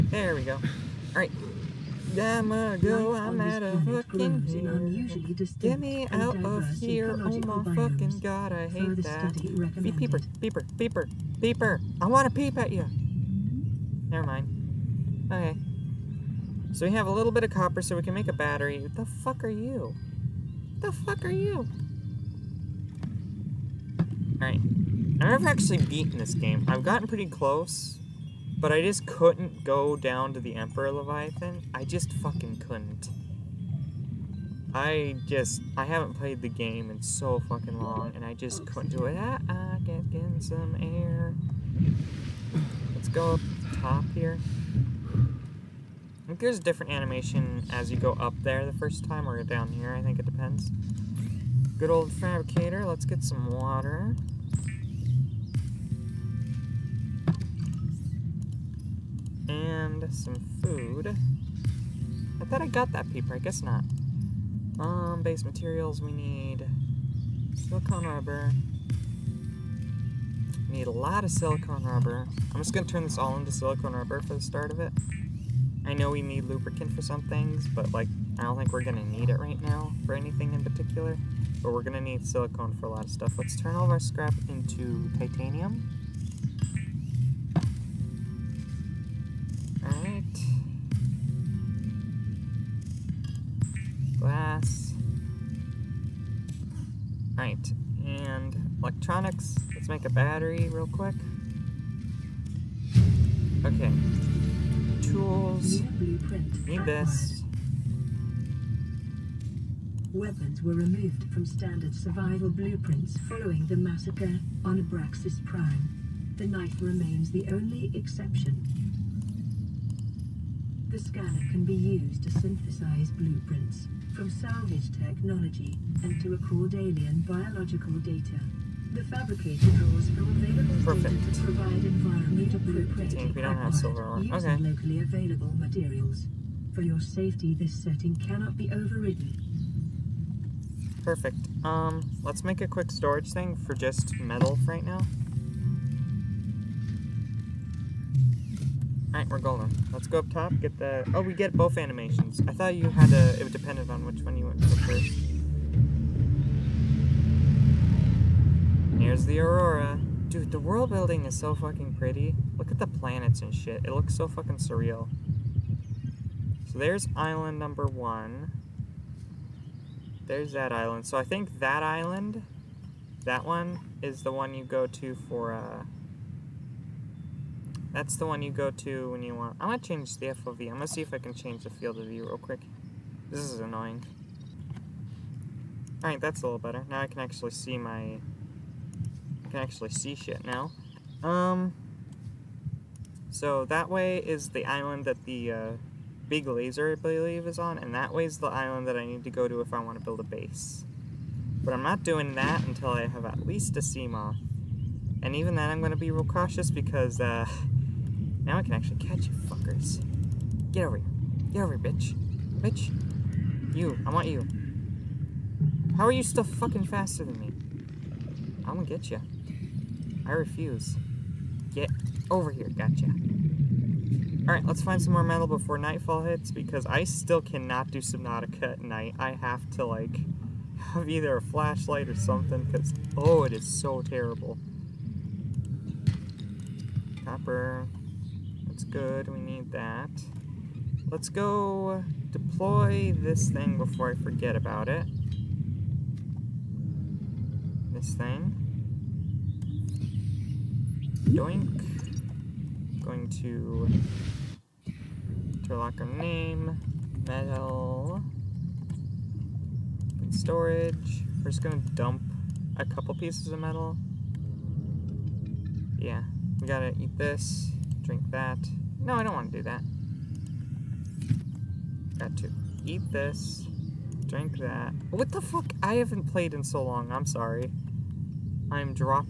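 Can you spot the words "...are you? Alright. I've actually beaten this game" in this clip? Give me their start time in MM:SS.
00:21.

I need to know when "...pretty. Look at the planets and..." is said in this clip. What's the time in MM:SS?
02:41.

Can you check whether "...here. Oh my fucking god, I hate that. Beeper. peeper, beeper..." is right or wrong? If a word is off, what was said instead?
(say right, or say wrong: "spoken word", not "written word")
right.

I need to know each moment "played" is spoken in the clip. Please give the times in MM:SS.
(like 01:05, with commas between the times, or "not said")
00:36, 04:36.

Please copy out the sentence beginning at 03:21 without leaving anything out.
But I'm not doing that until I have at least a Seamoth.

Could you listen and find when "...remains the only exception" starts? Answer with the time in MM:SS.
01:56.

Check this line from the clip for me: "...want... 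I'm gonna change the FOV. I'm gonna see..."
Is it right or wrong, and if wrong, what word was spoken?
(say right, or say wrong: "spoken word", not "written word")
right.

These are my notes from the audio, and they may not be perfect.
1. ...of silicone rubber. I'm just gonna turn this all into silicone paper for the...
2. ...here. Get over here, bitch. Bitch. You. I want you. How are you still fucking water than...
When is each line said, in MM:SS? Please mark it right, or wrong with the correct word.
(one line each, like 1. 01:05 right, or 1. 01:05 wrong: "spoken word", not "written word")
1. 01:11 wrong: "rubber", not "paper"
2. 03:30 wrong: "faster", not "water".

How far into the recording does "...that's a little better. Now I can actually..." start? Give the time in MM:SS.
03:06.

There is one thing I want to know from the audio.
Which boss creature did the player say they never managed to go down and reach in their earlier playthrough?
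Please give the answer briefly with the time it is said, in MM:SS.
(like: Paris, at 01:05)
Emperor Leviathan, at 00:30.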